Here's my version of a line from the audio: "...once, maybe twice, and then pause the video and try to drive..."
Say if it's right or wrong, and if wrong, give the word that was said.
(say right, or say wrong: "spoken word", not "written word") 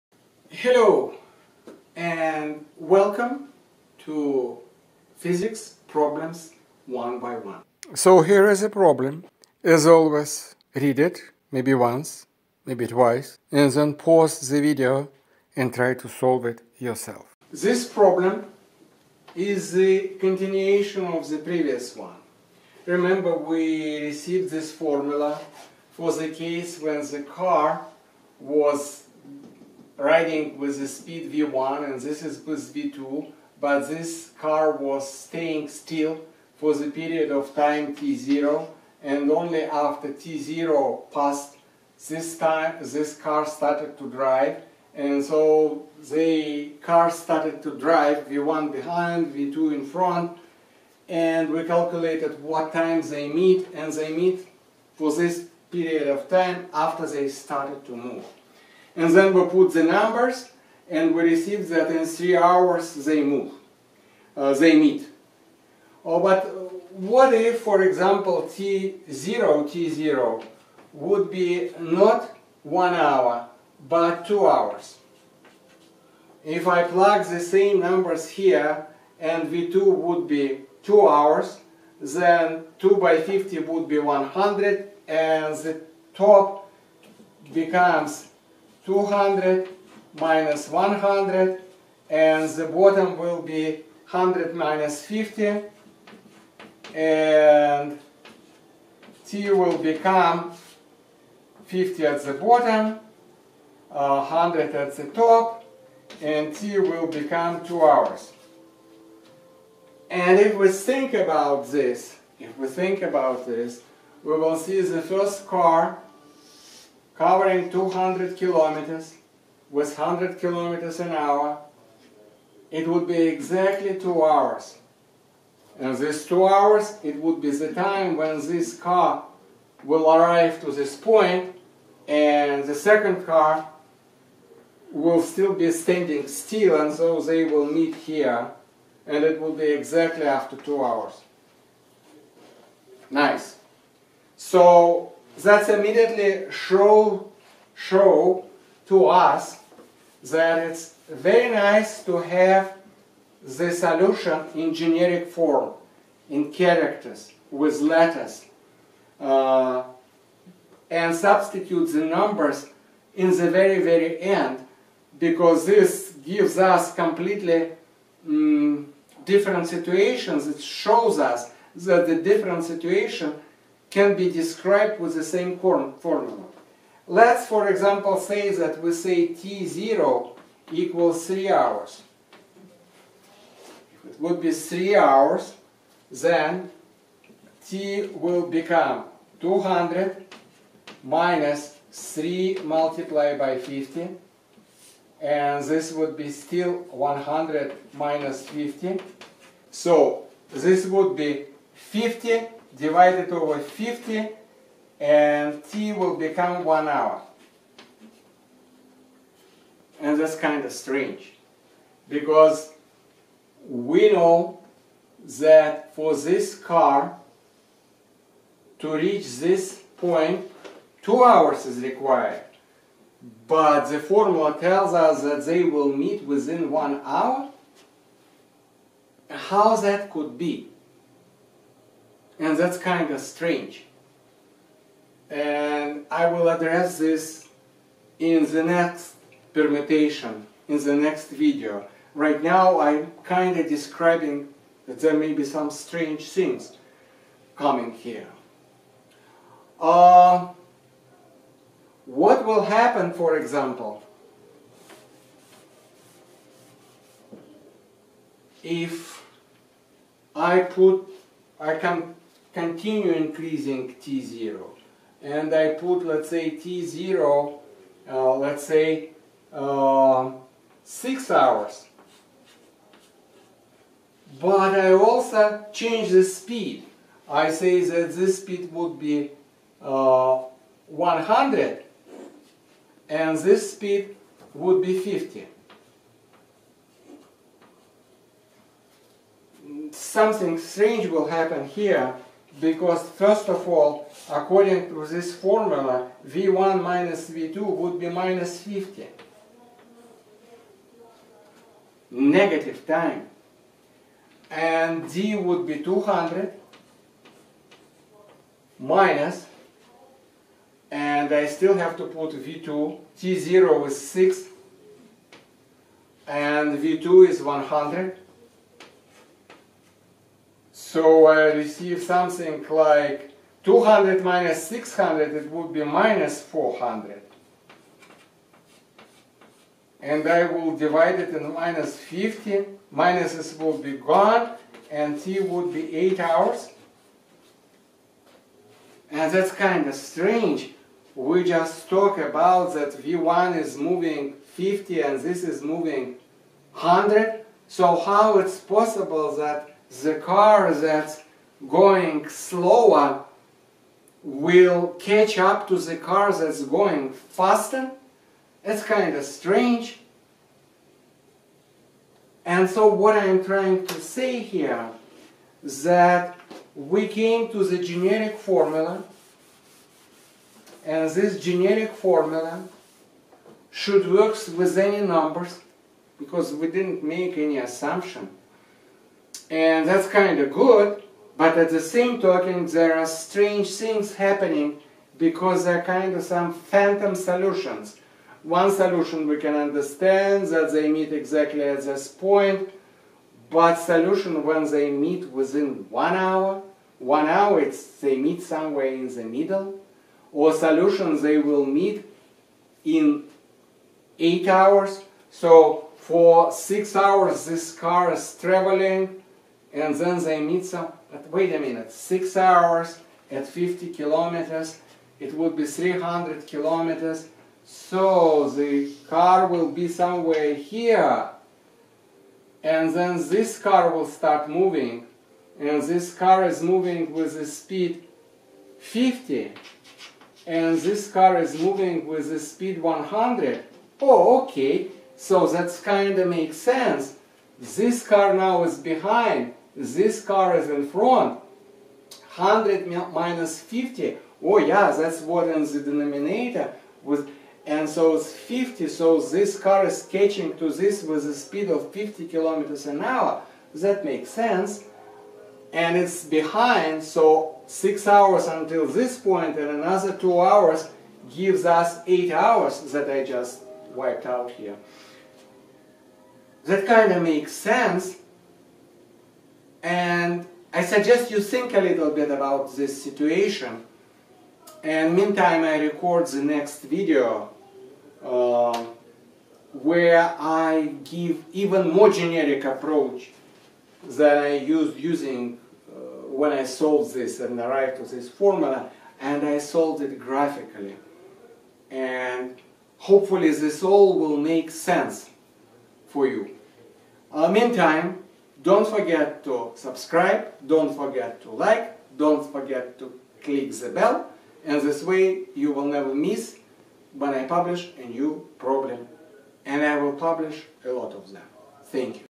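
wrong: "solve", not "drive".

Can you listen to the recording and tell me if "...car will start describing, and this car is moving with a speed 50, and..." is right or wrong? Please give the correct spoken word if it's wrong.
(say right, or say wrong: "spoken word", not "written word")
wrong: "moving", not "describing".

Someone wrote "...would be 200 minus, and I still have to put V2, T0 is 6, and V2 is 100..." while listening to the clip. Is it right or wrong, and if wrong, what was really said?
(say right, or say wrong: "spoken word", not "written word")
right.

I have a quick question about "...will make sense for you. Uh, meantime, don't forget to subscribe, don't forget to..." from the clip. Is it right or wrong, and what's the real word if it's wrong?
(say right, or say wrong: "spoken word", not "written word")
right.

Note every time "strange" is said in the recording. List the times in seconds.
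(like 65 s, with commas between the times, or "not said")
210 s, 233 s, 245 s, 290 s, 339 s, 359 s, 383 s.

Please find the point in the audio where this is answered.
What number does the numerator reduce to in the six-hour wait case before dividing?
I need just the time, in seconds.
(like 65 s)
325 s.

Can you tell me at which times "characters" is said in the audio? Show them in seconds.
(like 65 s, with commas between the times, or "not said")
156 s.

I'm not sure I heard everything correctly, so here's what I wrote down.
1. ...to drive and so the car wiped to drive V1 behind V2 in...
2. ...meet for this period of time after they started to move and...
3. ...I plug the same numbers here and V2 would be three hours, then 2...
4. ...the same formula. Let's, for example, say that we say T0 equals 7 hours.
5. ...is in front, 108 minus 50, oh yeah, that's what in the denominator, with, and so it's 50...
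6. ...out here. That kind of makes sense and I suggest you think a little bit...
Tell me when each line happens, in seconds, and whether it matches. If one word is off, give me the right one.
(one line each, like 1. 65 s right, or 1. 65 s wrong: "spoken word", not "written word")
1. 43 s wrong: "started", not "wiped"
2. 54 s right
3. 76 s wrong: "two", not "three"
4. 175 s wrong: "3", not "7"
5. 440 s wrong: "100", not "108"
6. 464 s right.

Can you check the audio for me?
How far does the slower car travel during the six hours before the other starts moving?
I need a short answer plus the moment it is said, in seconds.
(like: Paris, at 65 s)
300 kilometers, at 415 s.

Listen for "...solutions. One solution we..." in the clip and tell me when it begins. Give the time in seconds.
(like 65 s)
387 s.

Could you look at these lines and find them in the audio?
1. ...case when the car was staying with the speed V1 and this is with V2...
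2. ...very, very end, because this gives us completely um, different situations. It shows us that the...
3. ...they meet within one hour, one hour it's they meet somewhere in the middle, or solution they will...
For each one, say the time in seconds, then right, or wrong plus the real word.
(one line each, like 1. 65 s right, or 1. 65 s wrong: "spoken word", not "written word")
1. 26 s wrong: "riding", not "staying"
2. 163 s right
3. 394 s right.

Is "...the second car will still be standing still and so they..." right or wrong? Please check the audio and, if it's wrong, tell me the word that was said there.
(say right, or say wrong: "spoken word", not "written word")
right.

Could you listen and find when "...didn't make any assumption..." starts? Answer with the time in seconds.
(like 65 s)
376 s.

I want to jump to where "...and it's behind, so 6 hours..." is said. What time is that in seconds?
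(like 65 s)
455 s.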